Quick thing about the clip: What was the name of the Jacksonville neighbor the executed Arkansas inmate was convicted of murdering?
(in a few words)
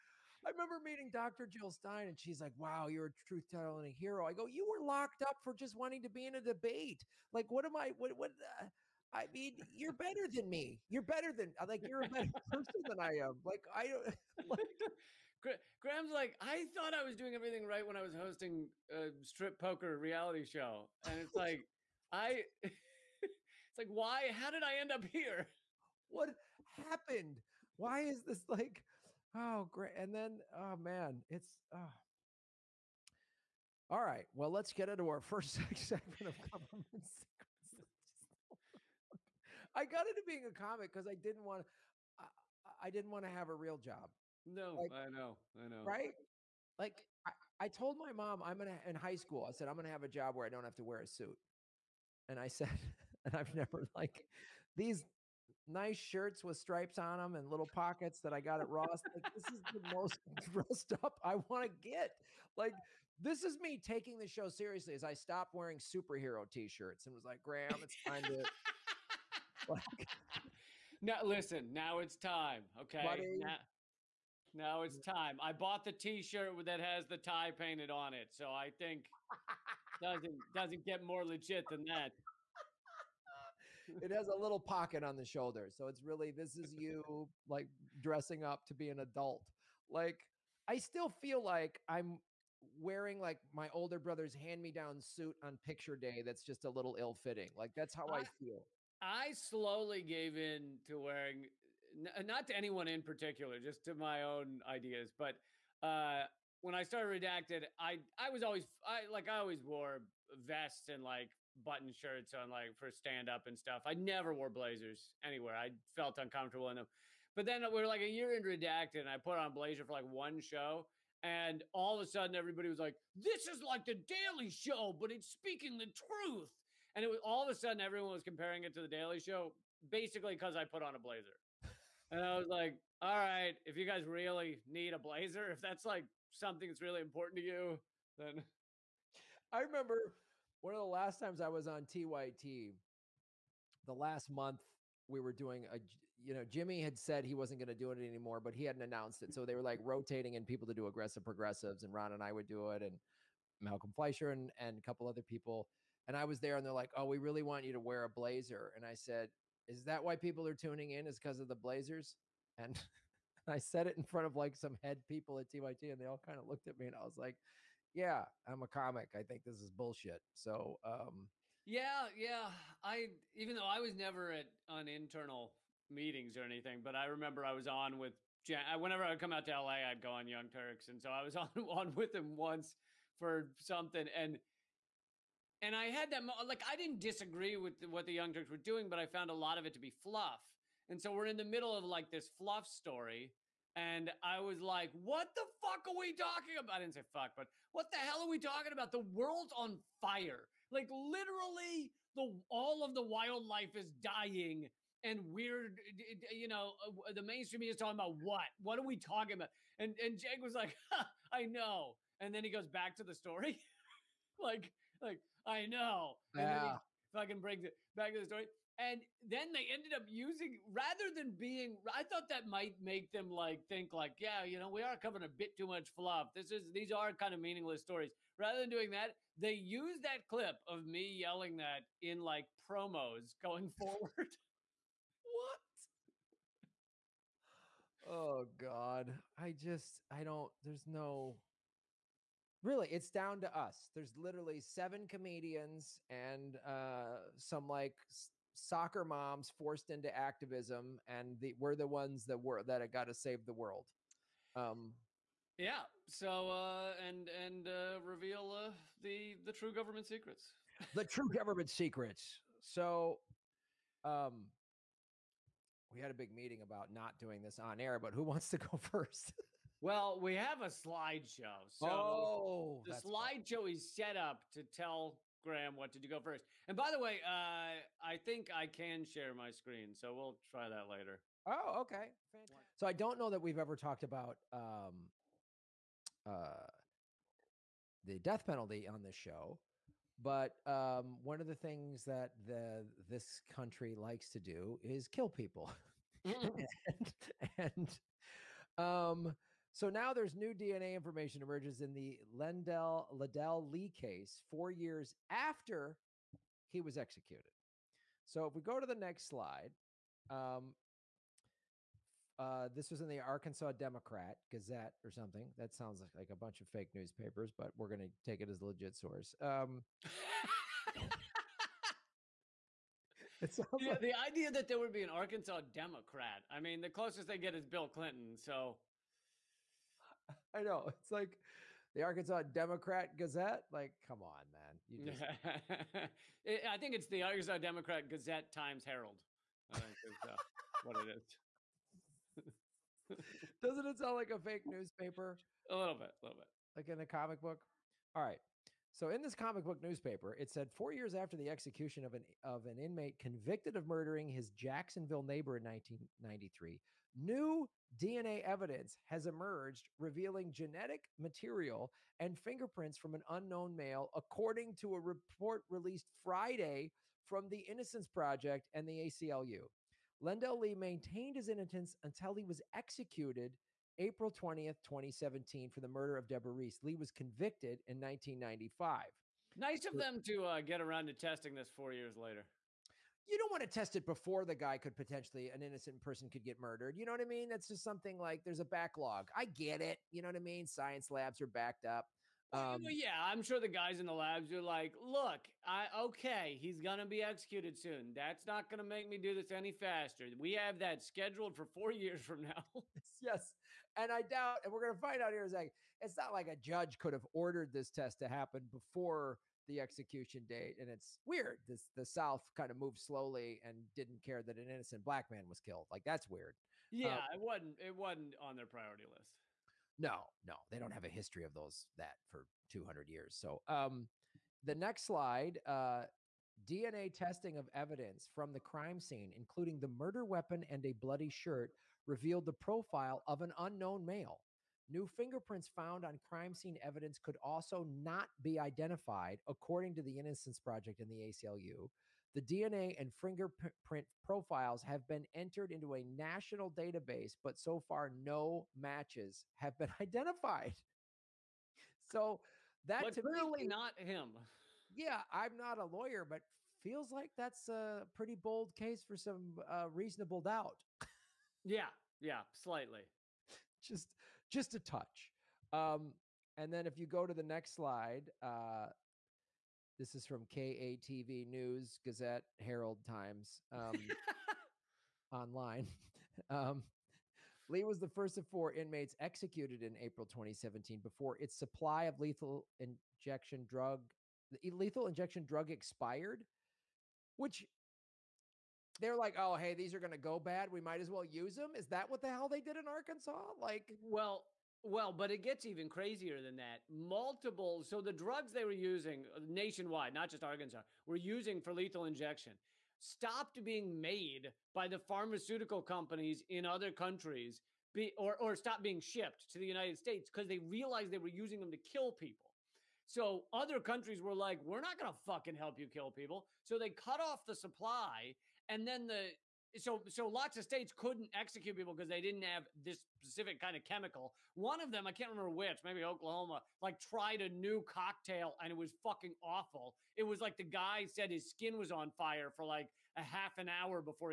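Deborah Reese.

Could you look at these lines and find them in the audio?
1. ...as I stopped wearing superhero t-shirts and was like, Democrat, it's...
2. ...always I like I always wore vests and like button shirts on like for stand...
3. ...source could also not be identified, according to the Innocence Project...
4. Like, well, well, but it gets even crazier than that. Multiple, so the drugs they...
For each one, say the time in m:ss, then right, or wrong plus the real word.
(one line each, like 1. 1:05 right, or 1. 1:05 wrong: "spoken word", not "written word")
1. 1:04 wrong: "Graham", not "Democrat"
2. 1:48 right
3. 7:16 wrong: "evidence", not "source"
4. 8:13 right.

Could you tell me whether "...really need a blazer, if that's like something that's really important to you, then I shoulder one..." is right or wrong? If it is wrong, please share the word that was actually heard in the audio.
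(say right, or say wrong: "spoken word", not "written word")
wrong: "remember", not "shoulder".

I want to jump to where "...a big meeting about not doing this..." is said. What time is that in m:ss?
4:26.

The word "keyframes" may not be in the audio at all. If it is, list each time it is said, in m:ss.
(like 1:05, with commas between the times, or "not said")
not said.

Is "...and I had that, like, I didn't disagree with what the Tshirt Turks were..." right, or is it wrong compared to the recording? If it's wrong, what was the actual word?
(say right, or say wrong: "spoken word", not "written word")
wrong: "Young", not "Tshirt".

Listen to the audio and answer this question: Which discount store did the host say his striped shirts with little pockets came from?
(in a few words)
Ross.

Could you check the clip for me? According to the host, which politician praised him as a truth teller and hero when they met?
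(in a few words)
Jill Stein.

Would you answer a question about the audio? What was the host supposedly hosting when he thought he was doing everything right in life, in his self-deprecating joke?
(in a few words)
a strip poker reality show.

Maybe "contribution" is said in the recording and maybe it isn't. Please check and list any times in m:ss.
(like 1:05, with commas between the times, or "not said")
not said.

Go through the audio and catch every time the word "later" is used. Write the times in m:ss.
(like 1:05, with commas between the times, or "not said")
4:40, 6:22.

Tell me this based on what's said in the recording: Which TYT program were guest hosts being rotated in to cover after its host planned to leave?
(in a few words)
Aggressive Progressives.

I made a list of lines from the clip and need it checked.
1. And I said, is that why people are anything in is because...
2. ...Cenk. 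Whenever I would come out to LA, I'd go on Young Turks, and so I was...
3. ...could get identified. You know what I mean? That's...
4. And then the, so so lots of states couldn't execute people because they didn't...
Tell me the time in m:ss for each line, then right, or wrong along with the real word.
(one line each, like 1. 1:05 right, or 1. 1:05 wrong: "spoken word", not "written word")
1. 2:38 wrong: "tuning", not "anything"
2. 2:58 right
3. 6:26 wrong: "murdered", not "identified"
4. 8:38 right.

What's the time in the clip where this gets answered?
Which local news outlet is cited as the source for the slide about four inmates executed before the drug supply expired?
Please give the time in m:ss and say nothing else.
7:50.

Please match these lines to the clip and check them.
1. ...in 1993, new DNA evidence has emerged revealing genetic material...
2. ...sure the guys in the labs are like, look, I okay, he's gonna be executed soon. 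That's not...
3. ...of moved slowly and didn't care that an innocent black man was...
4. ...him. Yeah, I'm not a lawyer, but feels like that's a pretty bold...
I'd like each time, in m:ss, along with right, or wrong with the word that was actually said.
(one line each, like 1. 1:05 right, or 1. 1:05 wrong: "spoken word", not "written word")
1. 5:55 right
2. 6:33 right
3. 6:52 right
4. 7:33 right.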